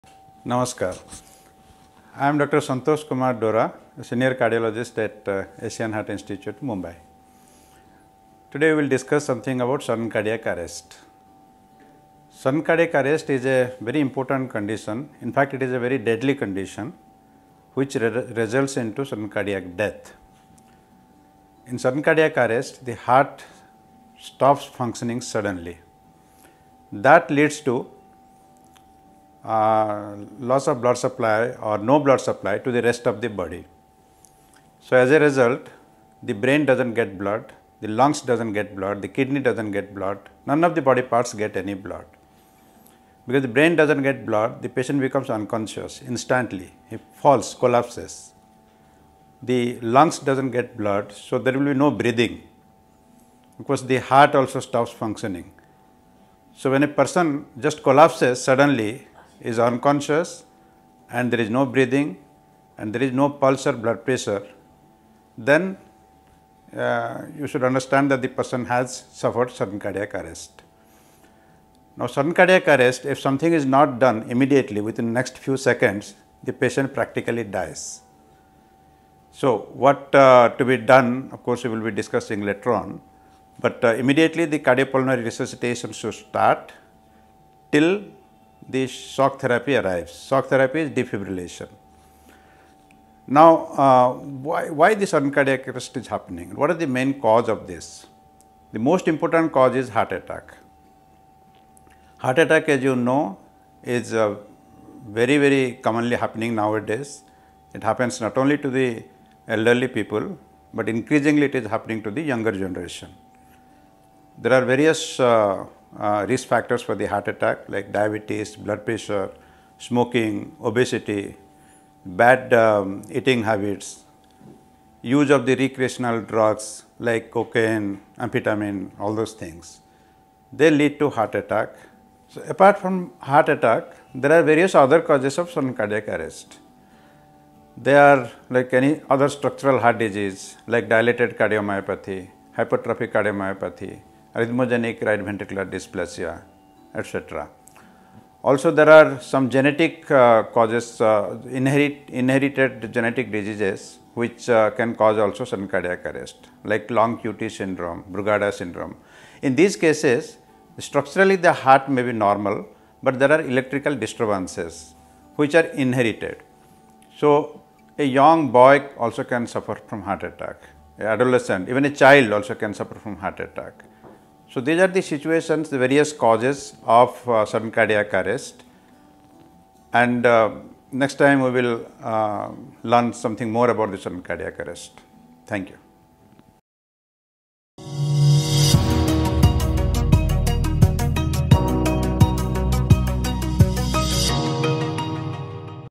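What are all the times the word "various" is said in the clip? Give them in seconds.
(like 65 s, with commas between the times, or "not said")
114 s, 134 s, 175 s.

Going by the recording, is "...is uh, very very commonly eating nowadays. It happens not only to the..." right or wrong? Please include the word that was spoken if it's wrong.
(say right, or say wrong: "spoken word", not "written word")
wrong: "happening", not "eating".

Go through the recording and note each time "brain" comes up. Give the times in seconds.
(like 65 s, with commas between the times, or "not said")
36 s, 43 s.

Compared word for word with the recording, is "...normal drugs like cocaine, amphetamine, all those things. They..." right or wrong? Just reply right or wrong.
wrong.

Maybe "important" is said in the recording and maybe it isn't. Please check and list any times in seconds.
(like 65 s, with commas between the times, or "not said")
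13 s, 99 s.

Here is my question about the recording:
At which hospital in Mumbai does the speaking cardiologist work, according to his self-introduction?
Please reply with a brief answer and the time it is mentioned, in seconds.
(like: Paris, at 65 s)
Asian Heart Institute, at 5 s.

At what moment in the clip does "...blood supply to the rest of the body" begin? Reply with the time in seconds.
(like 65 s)
31 s.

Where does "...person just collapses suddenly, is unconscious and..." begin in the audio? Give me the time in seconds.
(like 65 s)
56 s.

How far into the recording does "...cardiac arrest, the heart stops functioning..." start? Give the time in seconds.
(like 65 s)
22 s.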